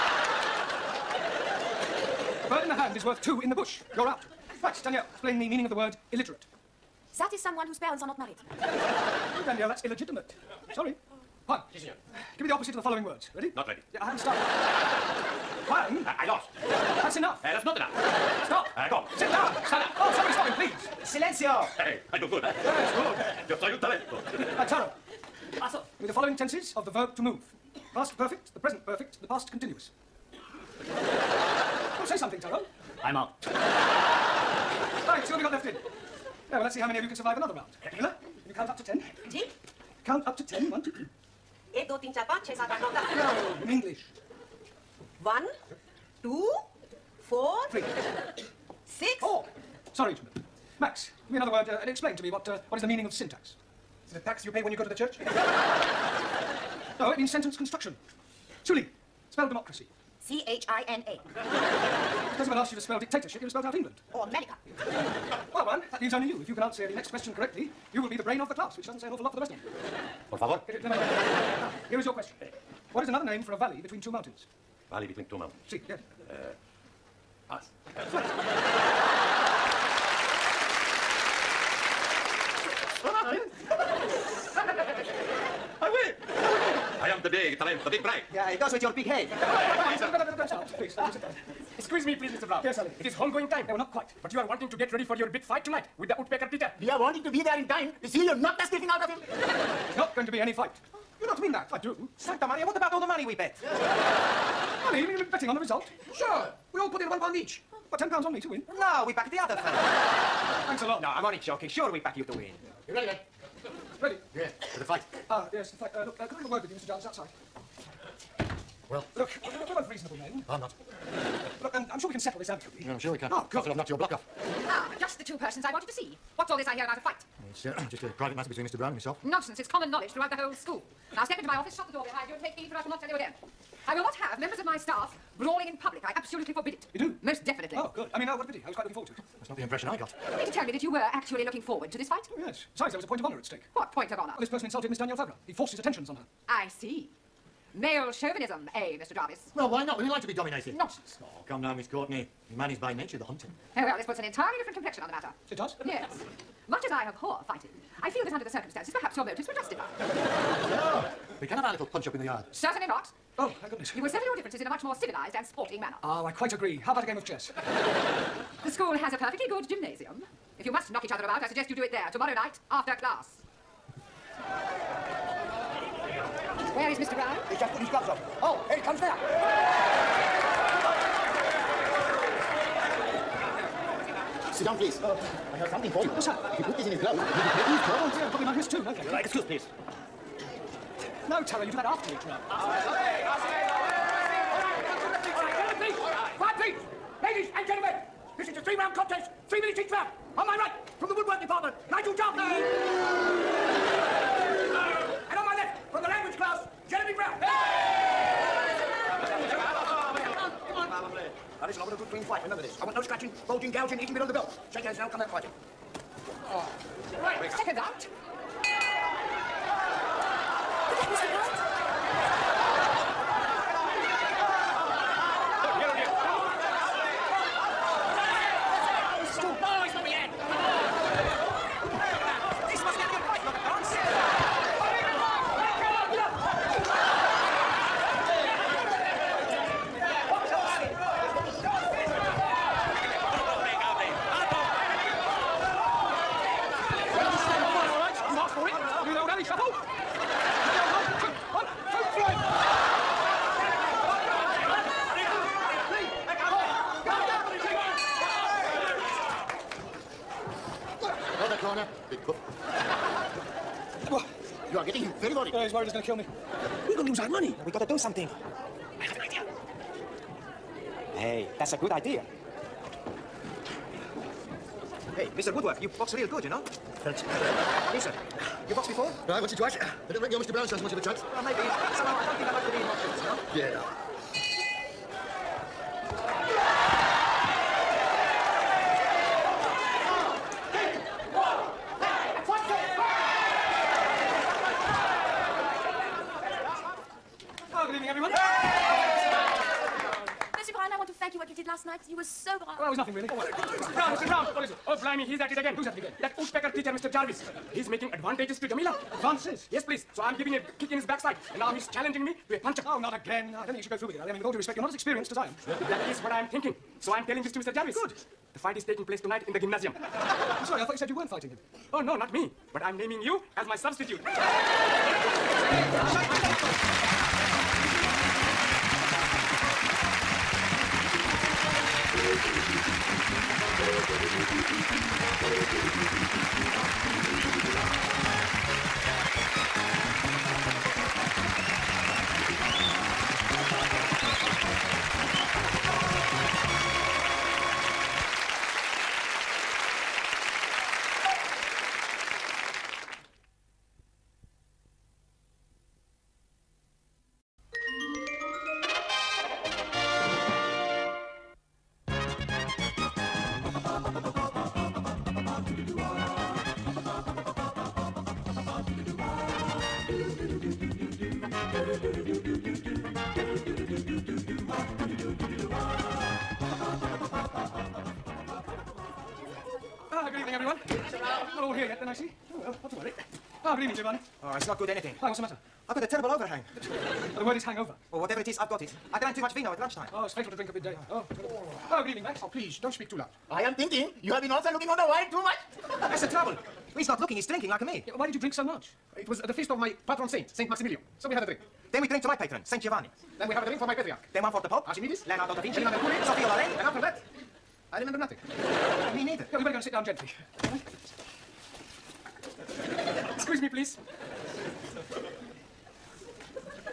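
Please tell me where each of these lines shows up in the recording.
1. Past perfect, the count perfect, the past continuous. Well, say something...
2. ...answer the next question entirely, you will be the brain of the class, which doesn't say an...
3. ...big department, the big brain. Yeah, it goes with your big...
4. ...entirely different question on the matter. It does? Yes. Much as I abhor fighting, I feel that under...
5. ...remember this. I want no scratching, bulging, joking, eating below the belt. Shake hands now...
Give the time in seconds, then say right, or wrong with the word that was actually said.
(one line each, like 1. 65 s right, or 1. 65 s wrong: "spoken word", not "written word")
1. 27 s wrong: "present", not "count"
2. 66 s wrong: "correctly", not "entirely"
3. 87 s wrong: "talent", not "department"
4. 154 s wrong: "complexion", not "question"
5. 212 s wrong: "gouging", not "joking".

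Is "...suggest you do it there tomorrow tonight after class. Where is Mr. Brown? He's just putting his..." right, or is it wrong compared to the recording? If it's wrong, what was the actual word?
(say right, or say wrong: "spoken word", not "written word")
wrong: "night", not "tonight".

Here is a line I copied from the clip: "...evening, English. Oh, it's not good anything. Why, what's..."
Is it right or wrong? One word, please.
wrong.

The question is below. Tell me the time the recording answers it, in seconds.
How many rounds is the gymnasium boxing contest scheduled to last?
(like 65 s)
198 s.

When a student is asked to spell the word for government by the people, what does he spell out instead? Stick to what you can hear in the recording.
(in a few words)
China.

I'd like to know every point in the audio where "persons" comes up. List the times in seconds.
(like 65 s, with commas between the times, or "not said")
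125 s, 144 s.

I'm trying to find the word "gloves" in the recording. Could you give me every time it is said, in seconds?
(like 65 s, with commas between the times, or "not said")
177 s, 187 s.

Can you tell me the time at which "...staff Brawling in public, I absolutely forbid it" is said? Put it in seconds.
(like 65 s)
134 s.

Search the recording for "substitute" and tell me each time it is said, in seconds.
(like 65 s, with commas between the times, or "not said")
323 s.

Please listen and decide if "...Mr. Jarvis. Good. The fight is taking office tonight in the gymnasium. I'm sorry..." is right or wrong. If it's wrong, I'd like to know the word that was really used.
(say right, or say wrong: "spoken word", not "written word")
wrong: "place", not "office".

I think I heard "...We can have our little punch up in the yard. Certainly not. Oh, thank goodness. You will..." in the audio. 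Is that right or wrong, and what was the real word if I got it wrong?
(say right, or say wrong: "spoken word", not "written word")
right.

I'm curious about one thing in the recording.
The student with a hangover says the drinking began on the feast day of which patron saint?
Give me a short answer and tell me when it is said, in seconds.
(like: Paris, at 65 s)
Saint Maximilian, at 400 s.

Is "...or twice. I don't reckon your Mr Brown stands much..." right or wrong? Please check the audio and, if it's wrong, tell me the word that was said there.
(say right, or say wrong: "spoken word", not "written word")
right.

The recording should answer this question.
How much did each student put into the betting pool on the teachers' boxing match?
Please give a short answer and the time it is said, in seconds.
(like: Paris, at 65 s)
1 pound, at 107 s.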